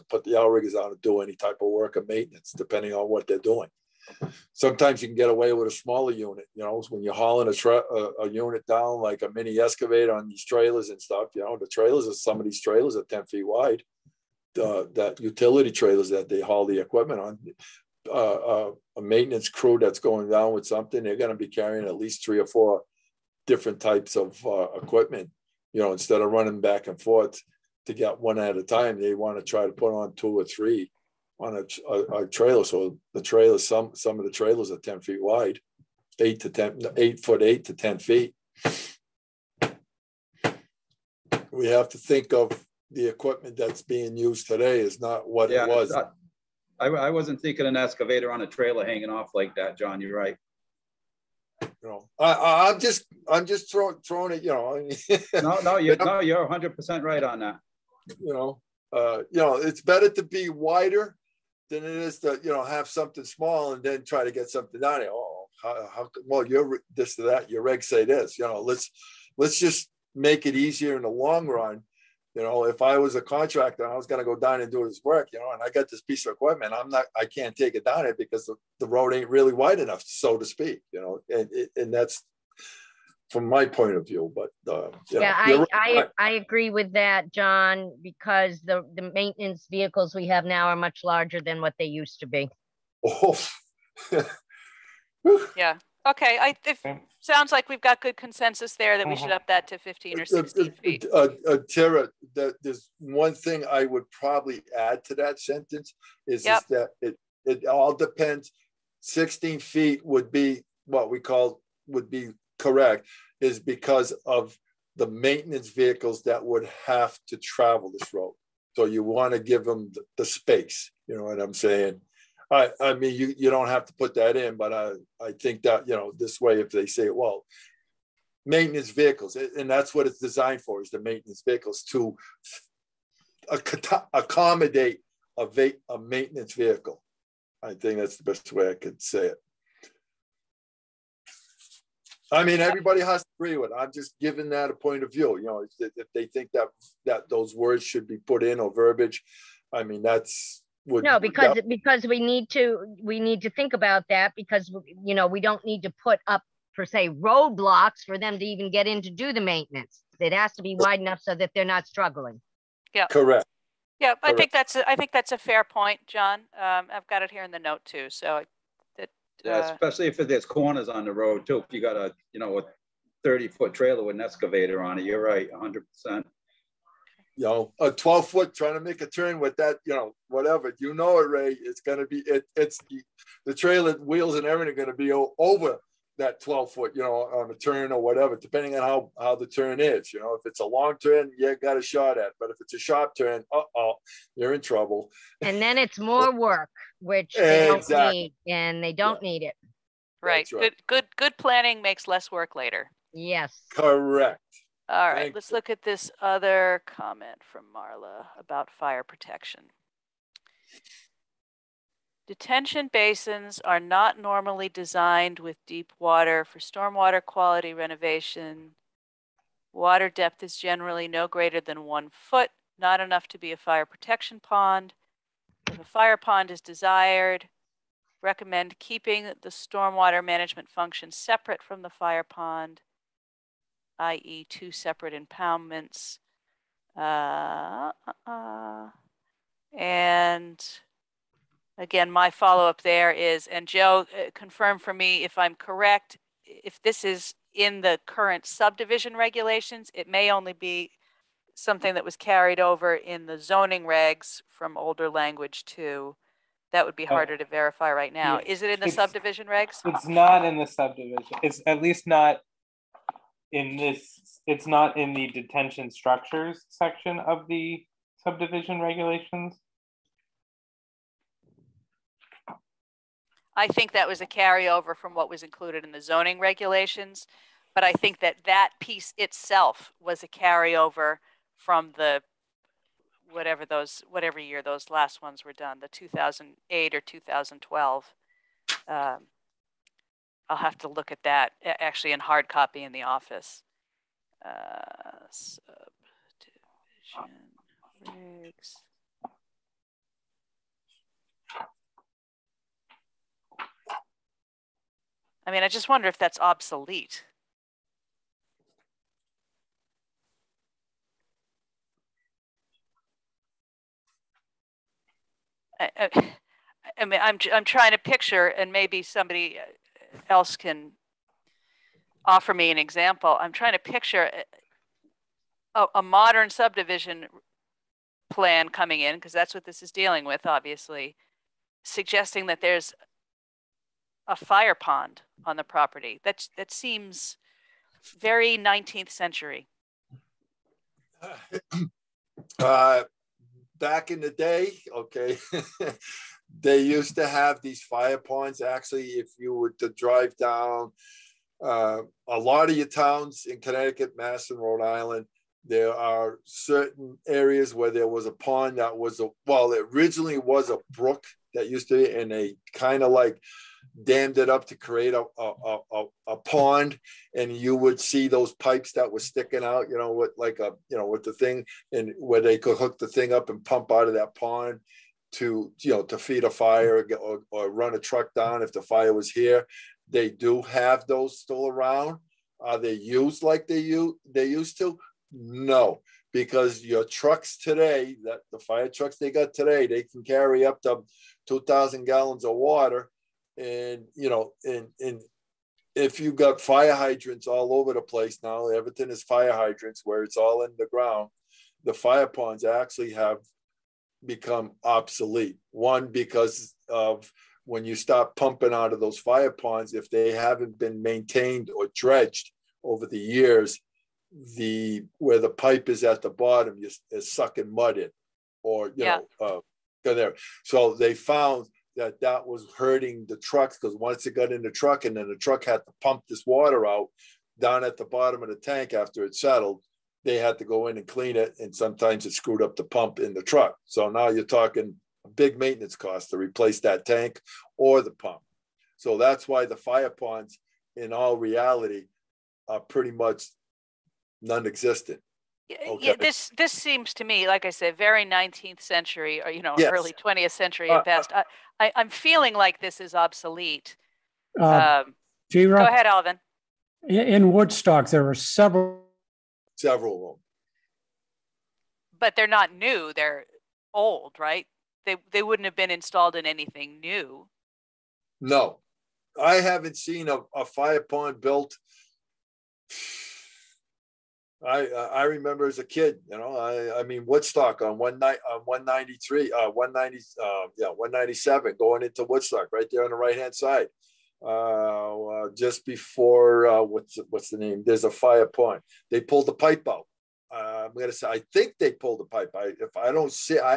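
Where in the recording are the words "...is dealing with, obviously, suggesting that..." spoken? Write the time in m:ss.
5:29.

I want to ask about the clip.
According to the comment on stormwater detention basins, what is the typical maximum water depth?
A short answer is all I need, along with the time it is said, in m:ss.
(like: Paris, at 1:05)
one foot, at 3:41.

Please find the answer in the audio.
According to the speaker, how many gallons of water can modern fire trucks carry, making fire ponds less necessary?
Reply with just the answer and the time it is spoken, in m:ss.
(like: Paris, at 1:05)
2,000 gallons, at 6:31.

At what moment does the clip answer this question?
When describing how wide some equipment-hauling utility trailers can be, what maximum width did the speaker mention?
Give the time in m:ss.
0:13.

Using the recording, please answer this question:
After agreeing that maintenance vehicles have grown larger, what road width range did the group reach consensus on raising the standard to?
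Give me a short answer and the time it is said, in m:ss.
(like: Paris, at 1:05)
15 or 16 feet, at 1:39.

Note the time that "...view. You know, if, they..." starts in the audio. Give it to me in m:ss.
2:25.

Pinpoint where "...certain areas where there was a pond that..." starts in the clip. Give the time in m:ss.
5:56.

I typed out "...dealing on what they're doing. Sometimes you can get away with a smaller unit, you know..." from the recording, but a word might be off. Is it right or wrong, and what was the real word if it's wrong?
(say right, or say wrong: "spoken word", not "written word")
wrong: "depending", not "dealing".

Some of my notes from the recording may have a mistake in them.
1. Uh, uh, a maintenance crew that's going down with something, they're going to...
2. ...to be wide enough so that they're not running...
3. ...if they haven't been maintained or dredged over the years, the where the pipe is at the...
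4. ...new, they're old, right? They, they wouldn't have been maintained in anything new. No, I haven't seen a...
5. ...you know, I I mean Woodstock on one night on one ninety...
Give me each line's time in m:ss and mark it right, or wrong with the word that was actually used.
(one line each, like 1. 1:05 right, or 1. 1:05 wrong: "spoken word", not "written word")
1. 0:18 right
2. 2:40 wrong: "struggling", not "running"
3. 6:49 right
4. 7:42 wrong: "installed", not "maintained"
5. 7:56 right.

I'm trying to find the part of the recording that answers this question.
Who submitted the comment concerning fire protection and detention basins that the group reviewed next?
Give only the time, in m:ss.
3:27.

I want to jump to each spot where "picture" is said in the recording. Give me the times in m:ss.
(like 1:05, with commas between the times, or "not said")
5:17, 5:23.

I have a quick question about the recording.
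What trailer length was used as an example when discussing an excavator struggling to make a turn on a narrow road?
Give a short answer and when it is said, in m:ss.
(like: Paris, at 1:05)
30 feet, at 2:53.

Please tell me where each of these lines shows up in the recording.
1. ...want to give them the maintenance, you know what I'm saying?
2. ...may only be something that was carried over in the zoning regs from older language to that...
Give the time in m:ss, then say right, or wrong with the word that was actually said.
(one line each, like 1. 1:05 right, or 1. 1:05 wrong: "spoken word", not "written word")
1. 1:59 wrong: "space", not "maintenance"
2. 4:10 right.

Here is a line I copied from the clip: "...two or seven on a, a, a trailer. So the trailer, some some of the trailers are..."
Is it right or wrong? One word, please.
wrong.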